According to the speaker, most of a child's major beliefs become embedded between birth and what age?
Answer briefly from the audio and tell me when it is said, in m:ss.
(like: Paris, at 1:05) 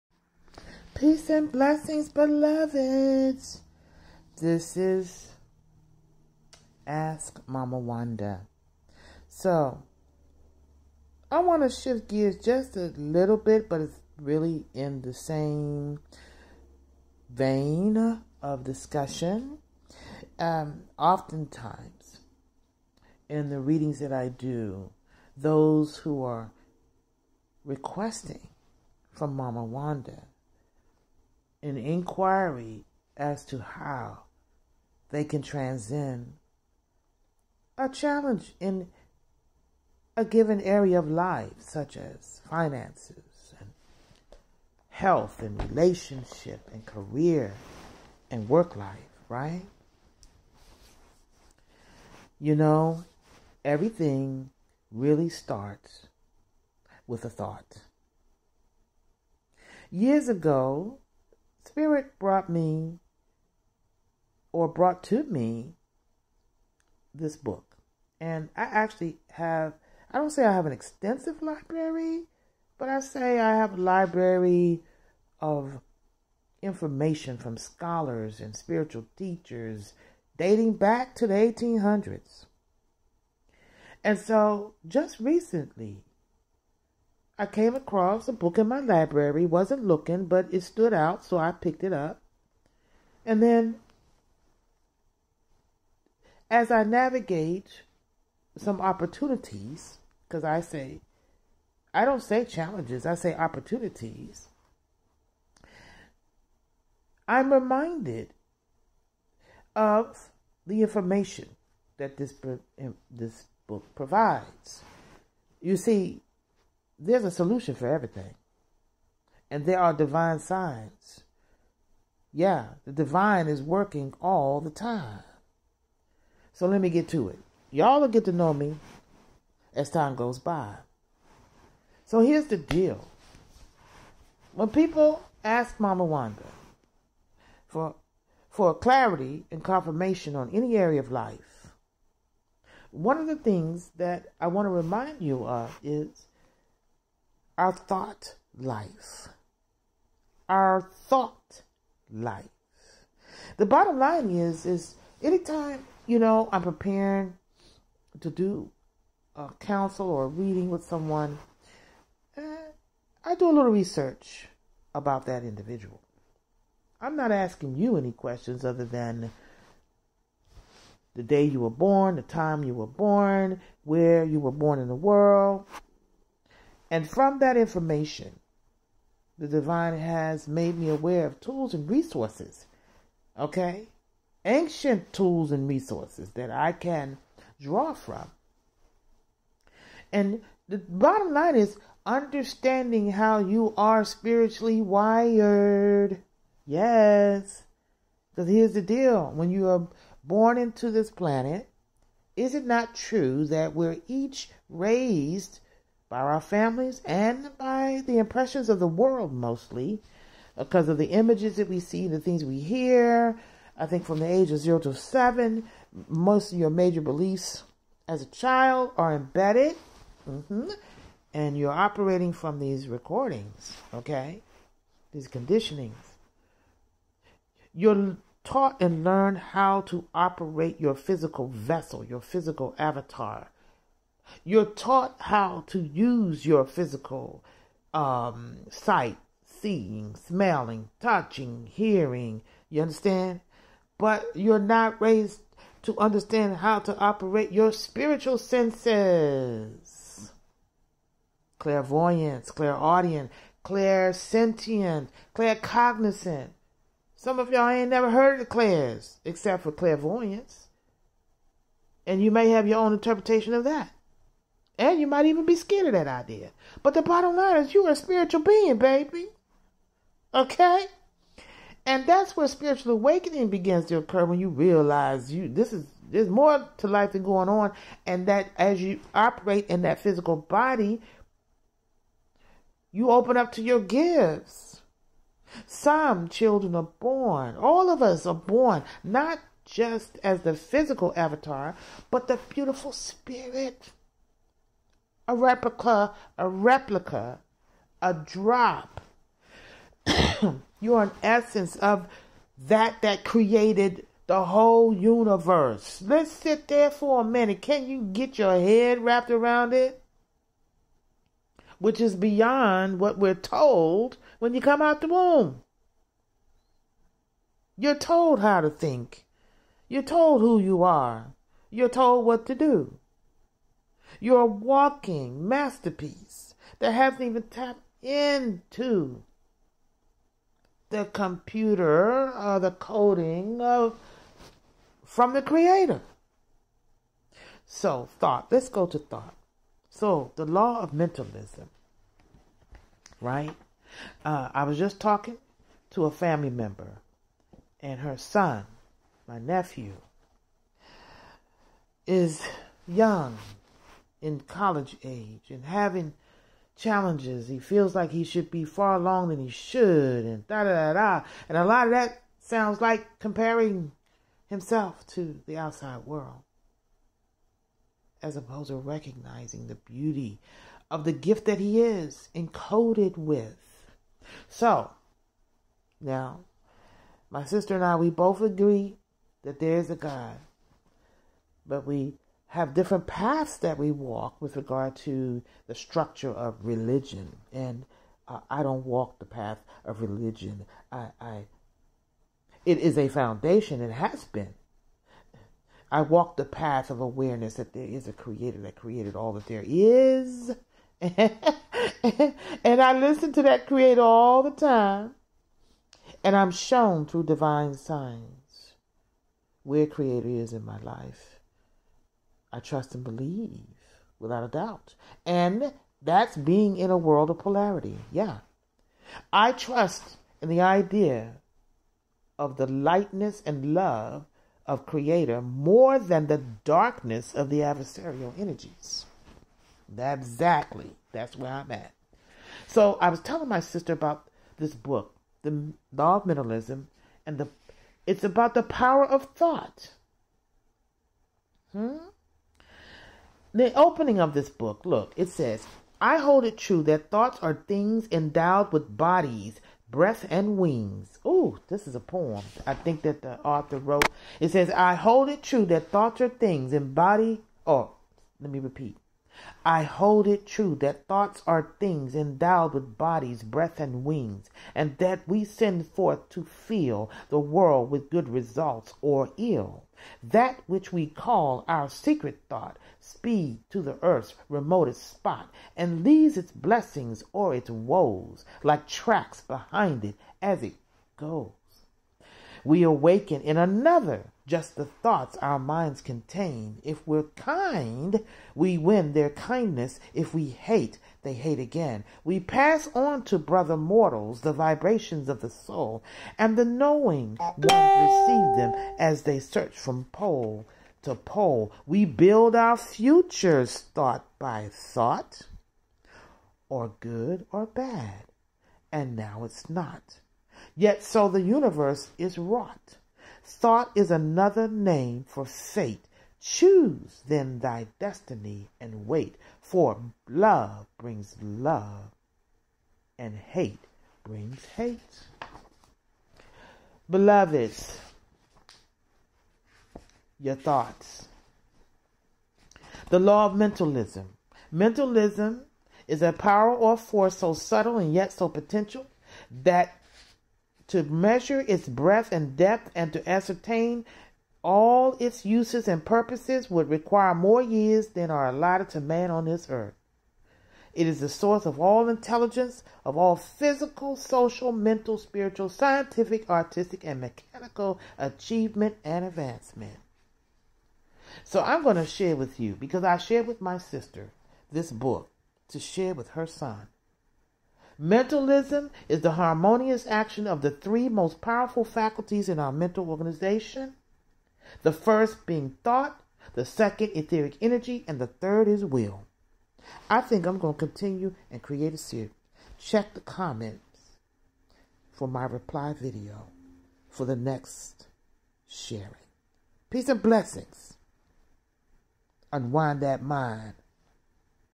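7, at 3:34.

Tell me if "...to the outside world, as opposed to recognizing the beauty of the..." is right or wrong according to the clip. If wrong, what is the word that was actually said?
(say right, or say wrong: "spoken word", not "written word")
right.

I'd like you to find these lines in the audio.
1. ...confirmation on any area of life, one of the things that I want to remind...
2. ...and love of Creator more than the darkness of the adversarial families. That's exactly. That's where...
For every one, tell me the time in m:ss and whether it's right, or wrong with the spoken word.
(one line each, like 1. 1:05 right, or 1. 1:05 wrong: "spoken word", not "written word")
1. 2:19 right
2. 7:03 wrong: "energies", not "families".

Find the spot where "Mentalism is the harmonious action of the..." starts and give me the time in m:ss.
9:28.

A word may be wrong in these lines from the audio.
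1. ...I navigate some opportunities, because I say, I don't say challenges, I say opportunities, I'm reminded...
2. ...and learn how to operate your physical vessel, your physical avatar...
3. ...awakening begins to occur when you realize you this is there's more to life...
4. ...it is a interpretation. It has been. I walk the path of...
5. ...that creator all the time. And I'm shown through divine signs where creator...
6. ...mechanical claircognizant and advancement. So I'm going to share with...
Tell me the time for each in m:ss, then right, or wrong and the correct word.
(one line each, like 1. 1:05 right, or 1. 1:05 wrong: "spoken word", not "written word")
1. 1:36 right
2. 3:48 right
3. 4:32 right
4. 6:32 wrong: "foundation", not "interpretation"
5. 6:43 right
6. 9:17 wrong: "achievement", not "claircognizant".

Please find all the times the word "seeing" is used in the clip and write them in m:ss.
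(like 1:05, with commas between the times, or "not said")
3:59.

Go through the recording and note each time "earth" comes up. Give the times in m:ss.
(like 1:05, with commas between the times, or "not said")
7:54, 9:09.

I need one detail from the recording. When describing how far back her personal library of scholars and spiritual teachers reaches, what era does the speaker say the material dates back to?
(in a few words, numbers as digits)
the 1800s.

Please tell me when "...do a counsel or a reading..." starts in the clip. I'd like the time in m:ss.
2:38.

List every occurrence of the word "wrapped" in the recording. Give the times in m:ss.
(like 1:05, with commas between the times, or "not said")
5:09.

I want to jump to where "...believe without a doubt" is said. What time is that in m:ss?
6:53.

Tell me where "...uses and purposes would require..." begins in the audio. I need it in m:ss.
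9:05.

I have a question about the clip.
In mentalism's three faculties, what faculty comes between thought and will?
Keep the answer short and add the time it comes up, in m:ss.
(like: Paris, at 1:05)
etheric energy, at 9:37.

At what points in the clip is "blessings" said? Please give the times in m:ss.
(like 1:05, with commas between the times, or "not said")
0:01, 7:56, 9:50.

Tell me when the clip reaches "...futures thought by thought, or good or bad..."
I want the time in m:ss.
8:22.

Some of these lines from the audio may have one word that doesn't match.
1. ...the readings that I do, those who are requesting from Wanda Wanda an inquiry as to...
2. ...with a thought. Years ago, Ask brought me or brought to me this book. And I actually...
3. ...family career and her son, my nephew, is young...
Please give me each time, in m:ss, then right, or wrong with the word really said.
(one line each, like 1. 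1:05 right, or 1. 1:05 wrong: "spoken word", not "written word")
1. 0:23 wrong: "Mama", not "Wanda"
2. 0:57 wrong: "Spirit", not "Ask"
3. 5:46 wrong: "member", not "career".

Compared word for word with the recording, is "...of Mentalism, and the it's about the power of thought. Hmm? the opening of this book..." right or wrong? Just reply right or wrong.
right.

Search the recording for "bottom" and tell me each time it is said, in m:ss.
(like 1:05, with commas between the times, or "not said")
2:33, 3:10, 4:27.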